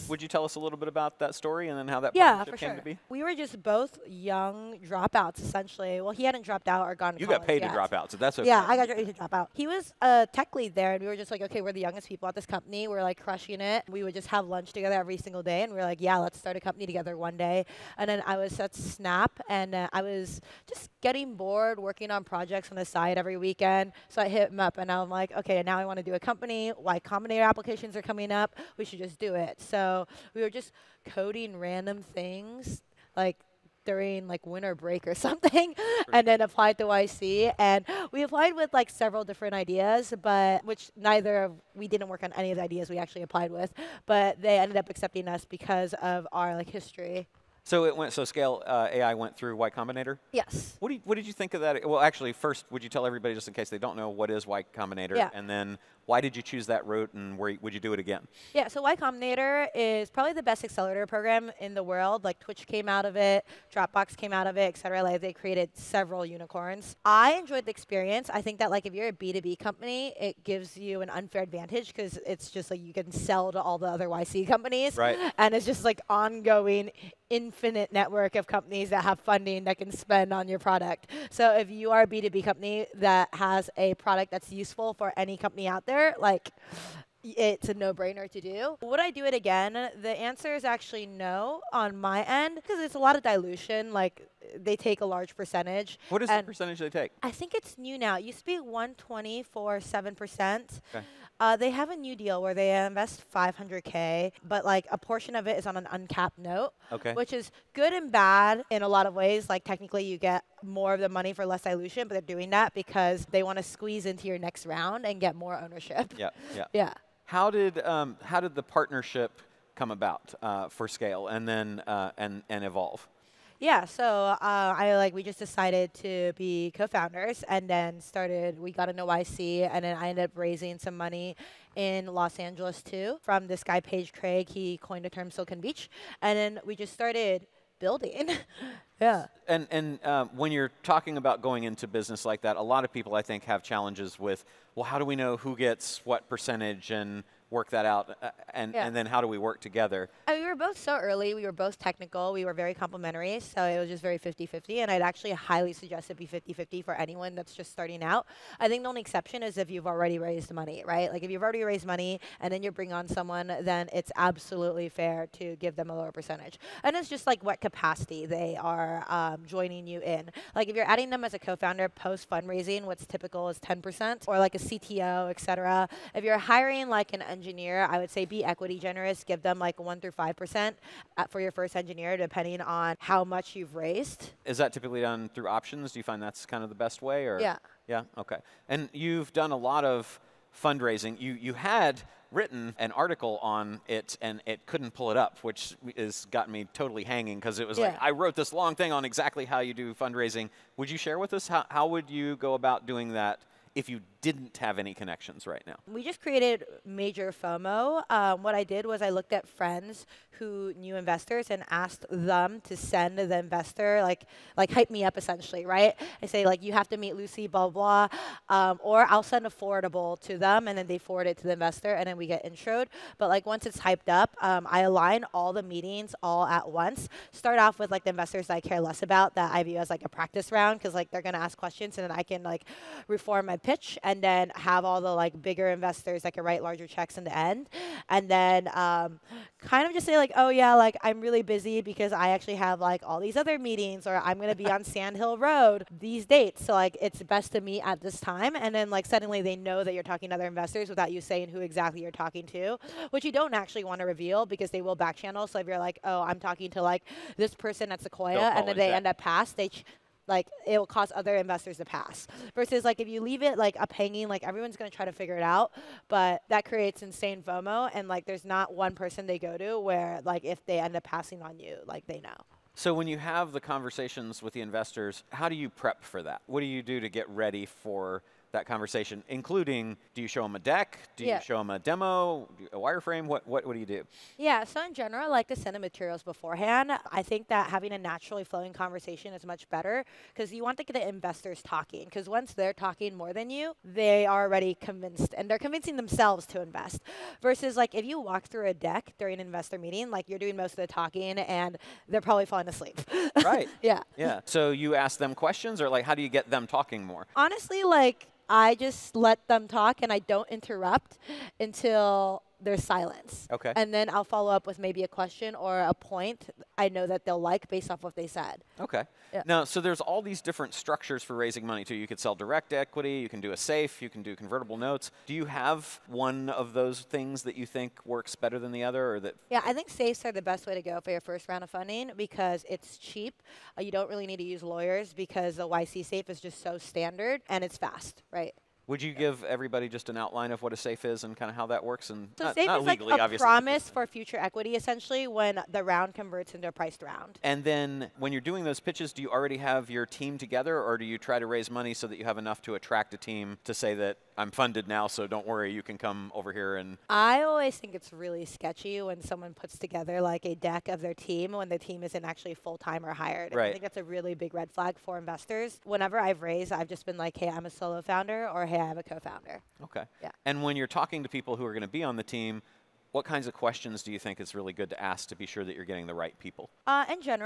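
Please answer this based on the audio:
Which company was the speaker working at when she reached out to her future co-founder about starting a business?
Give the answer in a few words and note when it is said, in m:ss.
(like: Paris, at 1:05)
Snap, at 0:18.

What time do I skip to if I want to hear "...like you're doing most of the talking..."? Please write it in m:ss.
5:00.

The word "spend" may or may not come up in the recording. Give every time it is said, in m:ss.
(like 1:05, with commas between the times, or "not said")
1:19.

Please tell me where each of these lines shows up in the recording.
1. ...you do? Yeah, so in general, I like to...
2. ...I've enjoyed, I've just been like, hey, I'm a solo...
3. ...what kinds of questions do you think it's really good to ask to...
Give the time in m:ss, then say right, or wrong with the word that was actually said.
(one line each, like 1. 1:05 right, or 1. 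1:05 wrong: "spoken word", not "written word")
1. 4:43 right
2. 6:06 wrong: "raised", not "enjoyed"
3. 6:13 right.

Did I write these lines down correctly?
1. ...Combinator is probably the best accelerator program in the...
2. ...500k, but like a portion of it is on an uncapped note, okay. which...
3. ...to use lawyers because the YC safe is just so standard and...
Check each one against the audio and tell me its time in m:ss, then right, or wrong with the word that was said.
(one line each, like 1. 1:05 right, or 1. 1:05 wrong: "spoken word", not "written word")
1. 0:58 right
2. 1:43 right
3. 5:34 right.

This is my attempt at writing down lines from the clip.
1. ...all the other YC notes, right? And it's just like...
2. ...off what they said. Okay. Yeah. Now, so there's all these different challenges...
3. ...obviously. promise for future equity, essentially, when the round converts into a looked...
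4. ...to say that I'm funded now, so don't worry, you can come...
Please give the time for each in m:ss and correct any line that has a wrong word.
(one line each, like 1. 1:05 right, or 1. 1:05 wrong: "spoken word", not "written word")
1. 1:13 wrong: "companies", not "notes"
2. 5:17 wrong: "structures", not "challenges"
3. 5:43 wrong: "priced", not "looked"
4. 5:53 right.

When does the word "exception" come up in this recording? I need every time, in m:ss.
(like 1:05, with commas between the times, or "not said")
2:39.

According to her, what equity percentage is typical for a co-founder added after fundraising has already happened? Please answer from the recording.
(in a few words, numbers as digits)
10%.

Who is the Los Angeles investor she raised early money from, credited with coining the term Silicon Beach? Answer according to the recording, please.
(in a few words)
Paige Craig.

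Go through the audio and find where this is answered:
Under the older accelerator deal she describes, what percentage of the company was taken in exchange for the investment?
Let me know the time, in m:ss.
1:39.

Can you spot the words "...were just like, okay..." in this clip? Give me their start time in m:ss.
0:11.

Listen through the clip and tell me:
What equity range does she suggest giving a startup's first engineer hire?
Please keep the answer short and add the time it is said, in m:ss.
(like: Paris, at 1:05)
1 to 5%, at 2:59.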